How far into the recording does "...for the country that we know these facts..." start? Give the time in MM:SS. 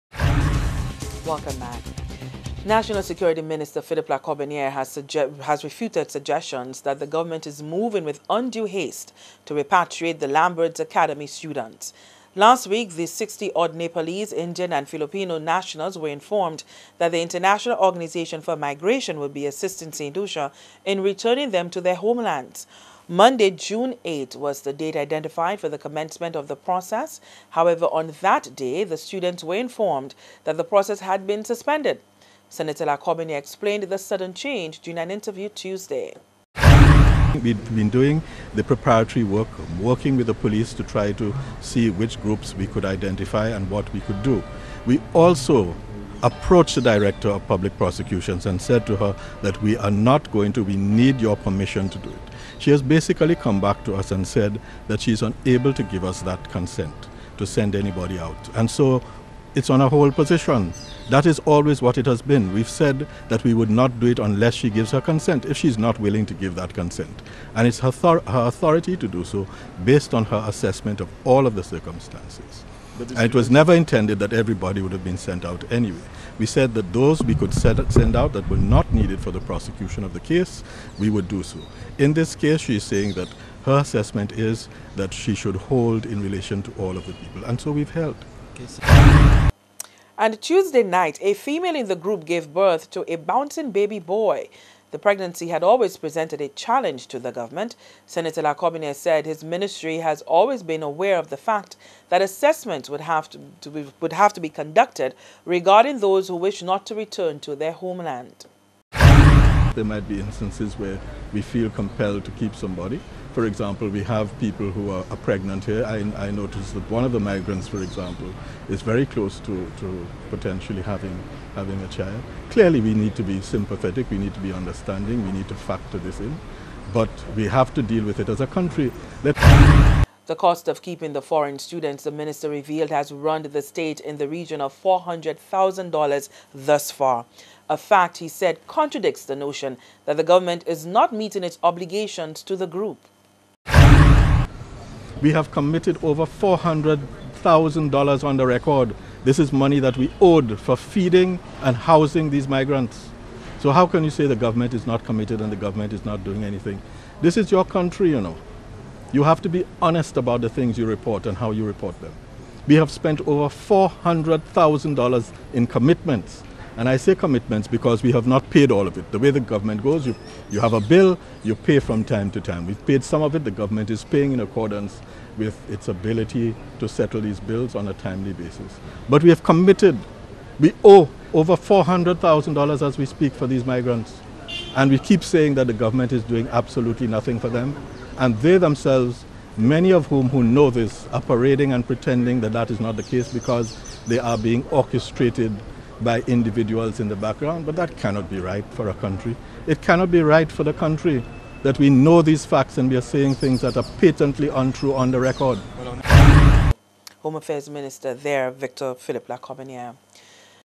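03:20.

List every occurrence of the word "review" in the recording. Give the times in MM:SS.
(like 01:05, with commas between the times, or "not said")
not said.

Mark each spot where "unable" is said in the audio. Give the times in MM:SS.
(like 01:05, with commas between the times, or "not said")
00:55.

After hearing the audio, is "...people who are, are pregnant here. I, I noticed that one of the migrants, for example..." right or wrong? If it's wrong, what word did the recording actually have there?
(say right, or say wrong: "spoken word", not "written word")
right.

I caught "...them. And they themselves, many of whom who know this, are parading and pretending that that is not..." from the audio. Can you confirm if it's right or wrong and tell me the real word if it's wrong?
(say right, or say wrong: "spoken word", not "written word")
right.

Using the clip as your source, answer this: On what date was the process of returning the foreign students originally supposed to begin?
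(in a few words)
Monday, June 8.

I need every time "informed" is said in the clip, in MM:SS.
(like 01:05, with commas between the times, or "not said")
00:16, 00:29.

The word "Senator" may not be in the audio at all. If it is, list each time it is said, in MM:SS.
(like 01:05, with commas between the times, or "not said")
00:32, 01:38.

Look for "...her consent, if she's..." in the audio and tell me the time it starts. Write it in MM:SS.
01:04.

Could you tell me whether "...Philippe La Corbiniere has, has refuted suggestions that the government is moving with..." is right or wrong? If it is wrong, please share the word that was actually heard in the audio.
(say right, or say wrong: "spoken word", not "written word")
right.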